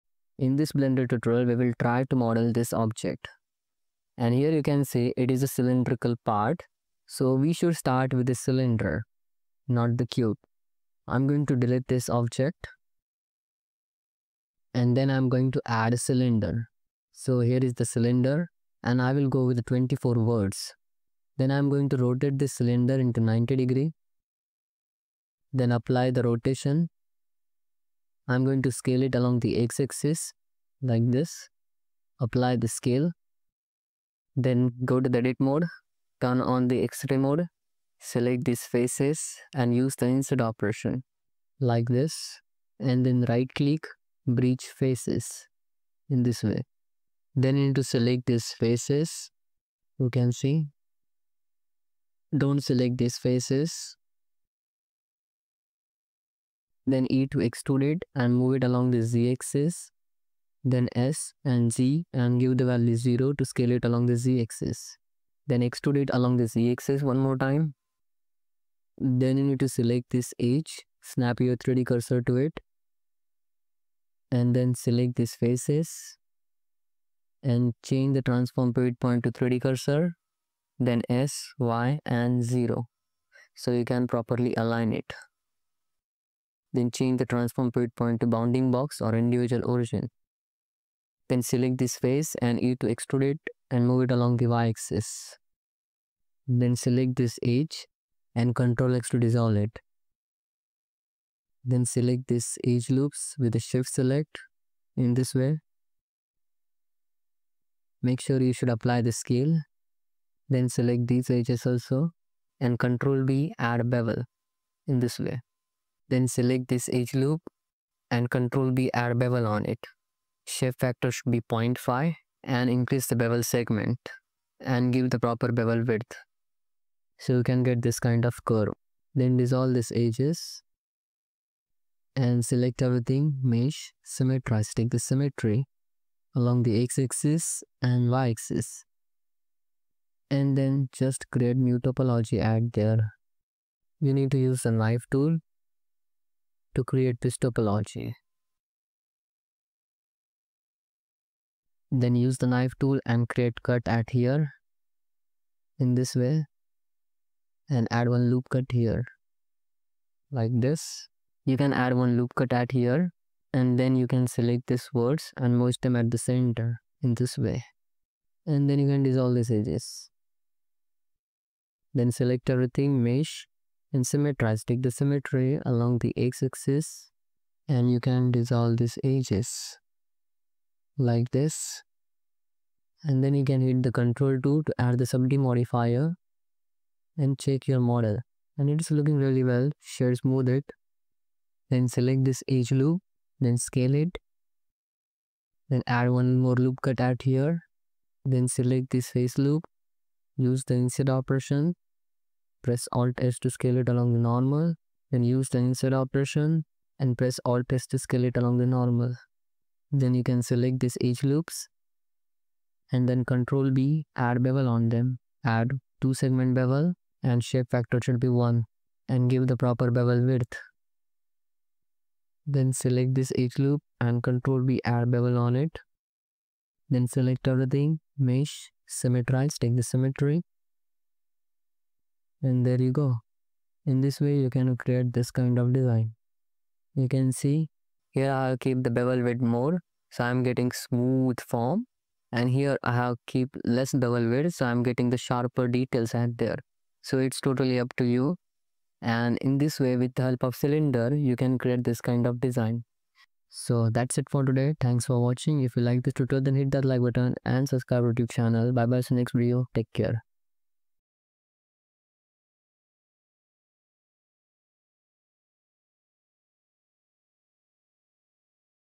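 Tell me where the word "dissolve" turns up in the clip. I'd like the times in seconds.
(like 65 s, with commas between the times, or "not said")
99 s, 129 s, 169 s, 178 s.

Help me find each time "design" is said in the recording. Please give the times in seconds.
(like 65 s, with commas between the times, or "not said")
235 s, 252 s.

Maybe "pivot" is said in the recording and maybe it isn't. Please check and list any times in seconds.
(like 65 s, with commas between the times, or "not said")
78 s, 87 s.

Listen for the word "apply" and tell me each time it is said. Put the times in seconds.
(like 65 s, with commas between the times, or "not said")
25 s, 32 s, 108 s.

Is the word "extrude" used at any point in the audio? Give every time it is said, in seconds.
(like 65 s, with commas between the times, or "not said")
57 s, 65 s, 92 s.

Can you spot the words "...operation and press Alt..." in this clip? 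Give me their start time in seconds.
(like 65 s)
205 s.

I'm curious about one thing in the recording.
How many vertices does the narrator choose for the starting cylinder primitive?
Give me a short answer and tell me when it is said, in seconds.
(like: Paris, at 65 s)
24, at 19 s.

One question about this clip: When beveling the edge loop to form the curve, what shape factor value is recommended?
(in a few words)
0.5.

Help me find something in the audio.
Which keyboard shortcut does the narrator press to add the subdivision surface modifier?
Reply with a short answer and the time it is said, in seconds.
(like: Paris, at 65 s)
Control 2, at 183 s.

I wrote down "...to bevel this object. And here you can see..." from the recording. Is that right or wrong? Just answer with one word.
wrong.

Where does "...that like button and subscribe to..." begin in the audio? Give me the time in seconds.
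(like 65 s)
256 s.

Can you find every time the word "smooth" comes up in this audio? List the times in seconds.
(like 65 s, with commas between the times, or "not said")
190 s, 240 s.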